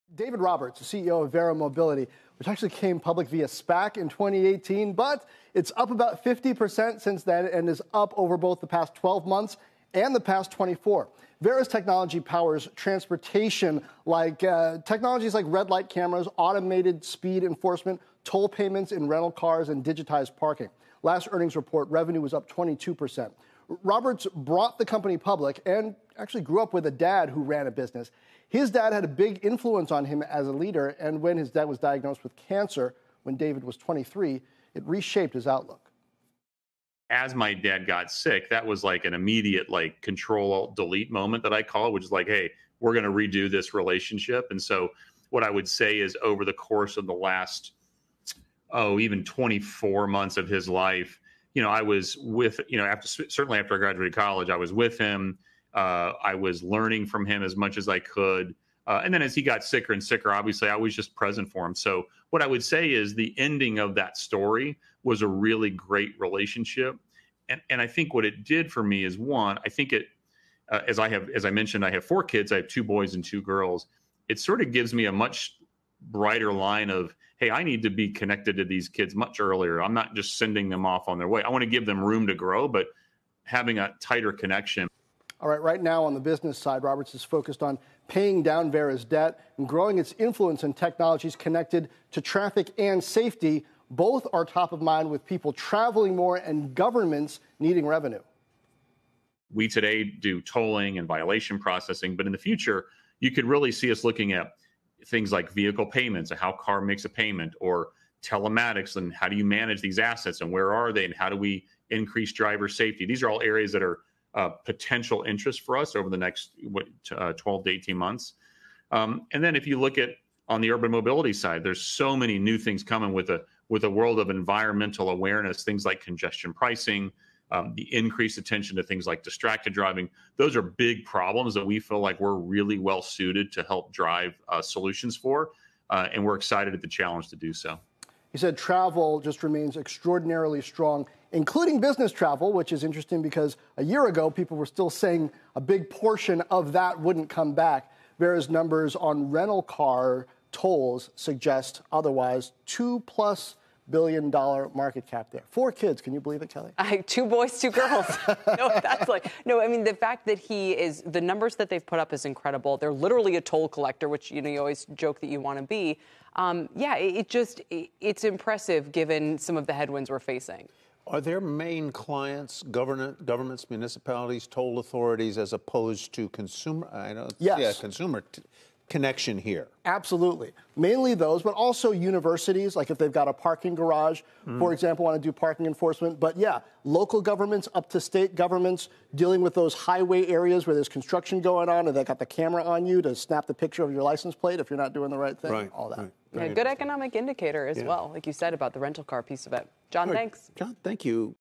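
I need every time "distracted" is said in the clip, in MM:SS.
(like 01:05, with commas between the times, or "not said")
02:09.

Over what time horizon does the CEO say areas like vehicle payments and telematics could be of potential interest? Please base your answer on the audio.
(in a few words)
12 to 18 months.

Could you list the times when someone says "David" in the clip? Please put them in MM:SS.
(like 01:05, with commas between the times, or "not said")
00:00, 00:33.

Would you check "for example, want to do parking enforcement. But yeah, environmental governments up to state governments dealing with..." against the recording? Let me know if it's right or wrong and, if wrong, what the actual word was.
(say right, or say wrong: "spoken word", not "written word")
wrong: "local", not "environmental".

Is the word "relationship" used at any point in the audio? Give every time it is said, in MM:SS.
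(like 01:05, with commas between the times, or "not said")
00:43, 01:06.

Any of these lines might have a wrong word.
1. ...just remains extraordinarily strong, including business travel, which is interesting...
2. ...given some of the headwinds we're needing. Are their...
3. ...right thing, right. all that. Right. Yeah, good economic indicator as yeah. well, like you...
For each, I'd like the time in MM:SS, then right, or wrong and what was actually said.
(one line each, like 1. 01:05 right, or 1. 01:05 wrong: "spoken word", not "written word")
1. 02:19 right
2. 02:48 wrong: "facing", not "needing"
3. 03:15 right.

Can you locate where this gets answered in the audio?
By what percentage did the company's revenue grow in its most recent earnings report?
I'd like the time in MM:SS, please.
00:22.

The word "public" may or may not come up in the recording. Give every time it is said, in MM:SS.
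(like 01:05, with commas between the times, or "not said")
00:02, 00:25.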